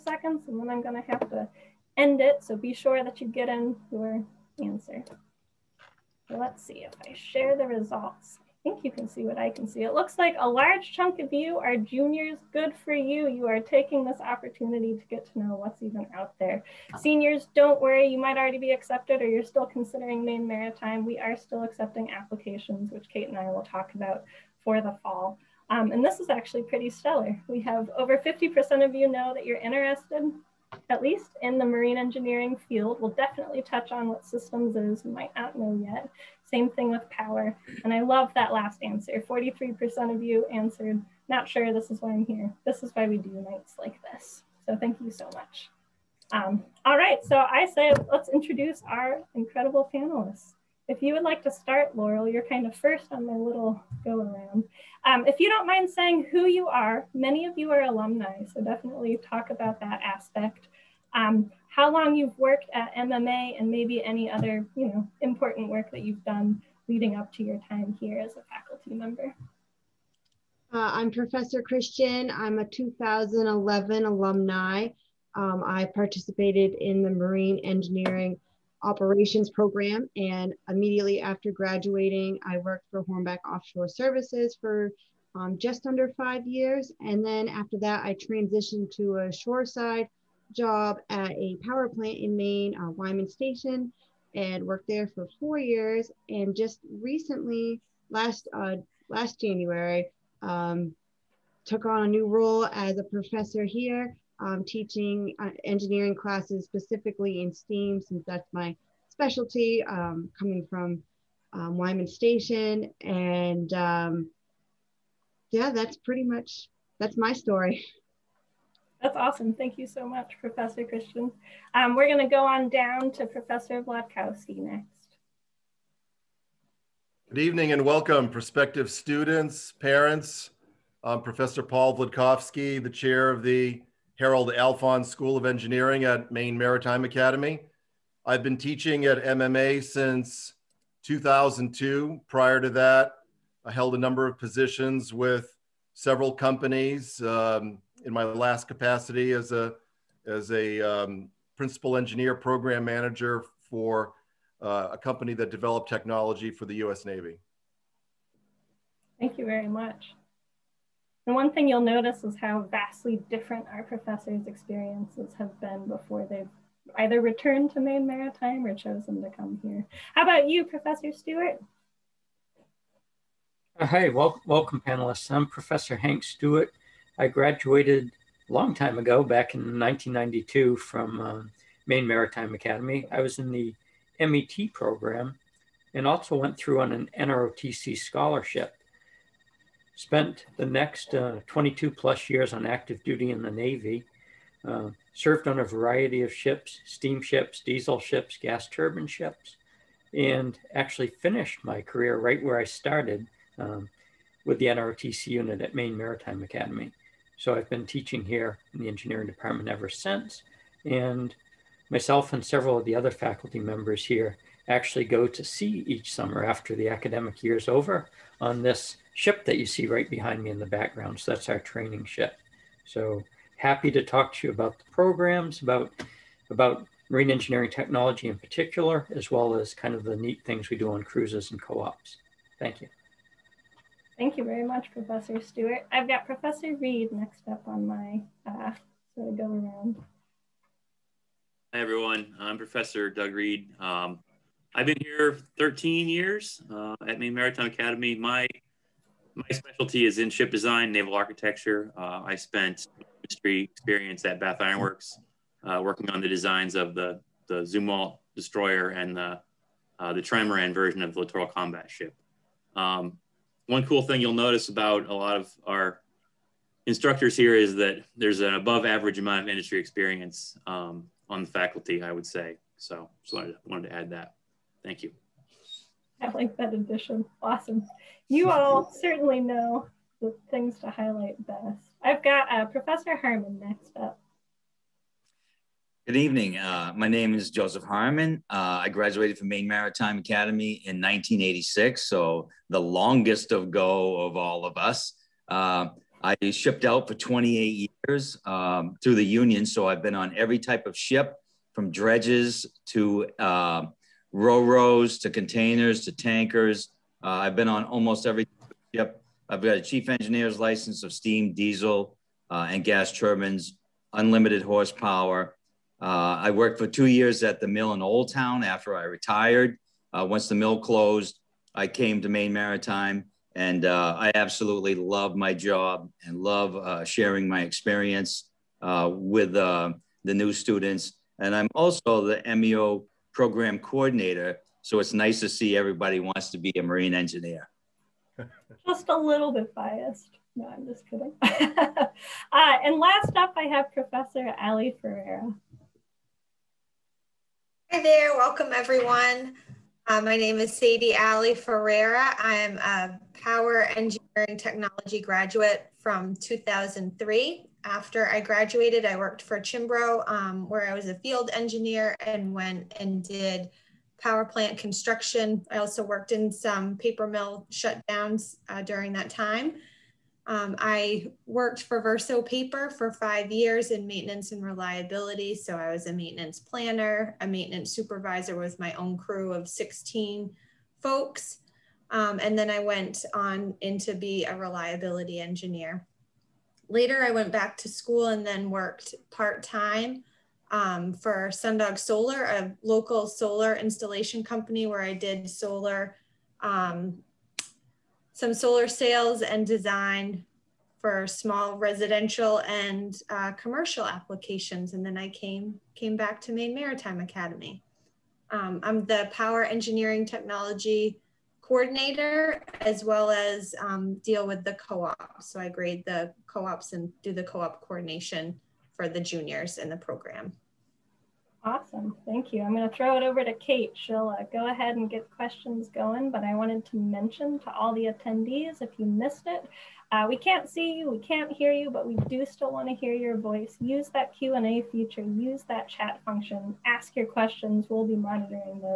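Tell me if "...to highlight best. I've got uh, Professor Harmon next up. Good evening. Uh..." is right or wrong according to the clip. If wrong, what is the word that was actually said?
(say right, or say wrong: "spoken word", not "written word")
right.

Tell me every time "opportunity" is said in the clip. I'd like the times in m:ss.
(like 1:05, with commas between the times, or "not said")
0:14.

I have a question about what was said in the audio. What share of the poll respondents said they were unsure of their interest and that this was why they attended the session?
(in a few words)
43%.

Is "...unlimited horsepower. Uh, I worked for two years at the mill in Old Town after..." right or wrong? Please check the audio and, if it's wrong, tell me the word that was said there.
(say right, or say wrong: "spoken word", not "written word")
right.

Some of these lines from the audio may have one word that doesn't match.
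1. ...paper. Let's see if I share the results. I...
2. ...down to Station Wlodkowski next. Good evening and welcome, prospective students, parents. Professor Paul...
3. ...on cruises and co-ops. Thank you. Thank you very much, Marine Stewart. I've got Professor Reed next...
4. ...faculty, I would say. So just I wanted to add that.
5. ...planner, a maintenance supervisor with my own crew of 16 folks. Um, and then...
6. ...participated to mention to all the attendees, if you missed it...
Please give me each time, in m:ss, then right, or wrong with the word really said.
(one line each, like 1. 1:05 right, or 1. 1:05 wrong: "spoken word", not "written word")
1. 0:04 wrong: "answer", not "paper"
2. 2:02 wrong: "Professor", not "Station"
3. 3:50 wrong: "Professor", not "Marine"
4. 4:31 right
5. 6:16 right
6. 7:06 wrong: "wanted", not "participated".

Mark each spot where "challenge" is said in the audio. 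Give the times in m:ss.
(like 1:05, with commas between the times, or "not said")
not said.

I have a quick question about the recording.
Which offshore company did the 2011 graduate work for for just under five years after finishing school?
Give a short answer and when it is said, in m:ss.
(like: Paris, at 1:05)
Hornbeck Offshore Services, at 1:23.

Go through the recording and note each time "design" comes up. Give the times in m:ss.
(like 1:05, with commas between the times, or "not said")
4:10, 4:16, 6:39.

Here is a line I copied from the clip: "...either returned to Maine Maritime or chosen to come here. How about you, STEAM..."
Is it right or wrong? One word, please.
wrong.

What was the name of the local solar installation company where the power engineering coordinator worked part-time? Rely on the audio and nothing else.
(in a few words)
Sundog Solar.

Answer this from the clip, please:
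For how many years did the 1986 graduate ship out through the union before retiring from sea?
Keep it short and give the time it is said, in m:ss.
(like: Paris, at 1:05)
28, at 4:57.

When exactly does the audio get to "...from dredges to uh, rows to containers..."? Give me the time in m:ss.
5:01.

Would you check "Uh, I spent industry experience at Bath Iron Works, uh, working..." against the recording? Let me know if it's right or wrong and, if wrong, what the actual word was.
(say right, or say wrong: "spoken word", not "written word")
right.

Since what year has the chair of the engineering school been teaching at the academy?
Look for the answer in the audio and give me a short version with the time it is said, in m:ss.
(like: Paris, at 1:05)
2002, at 2:21.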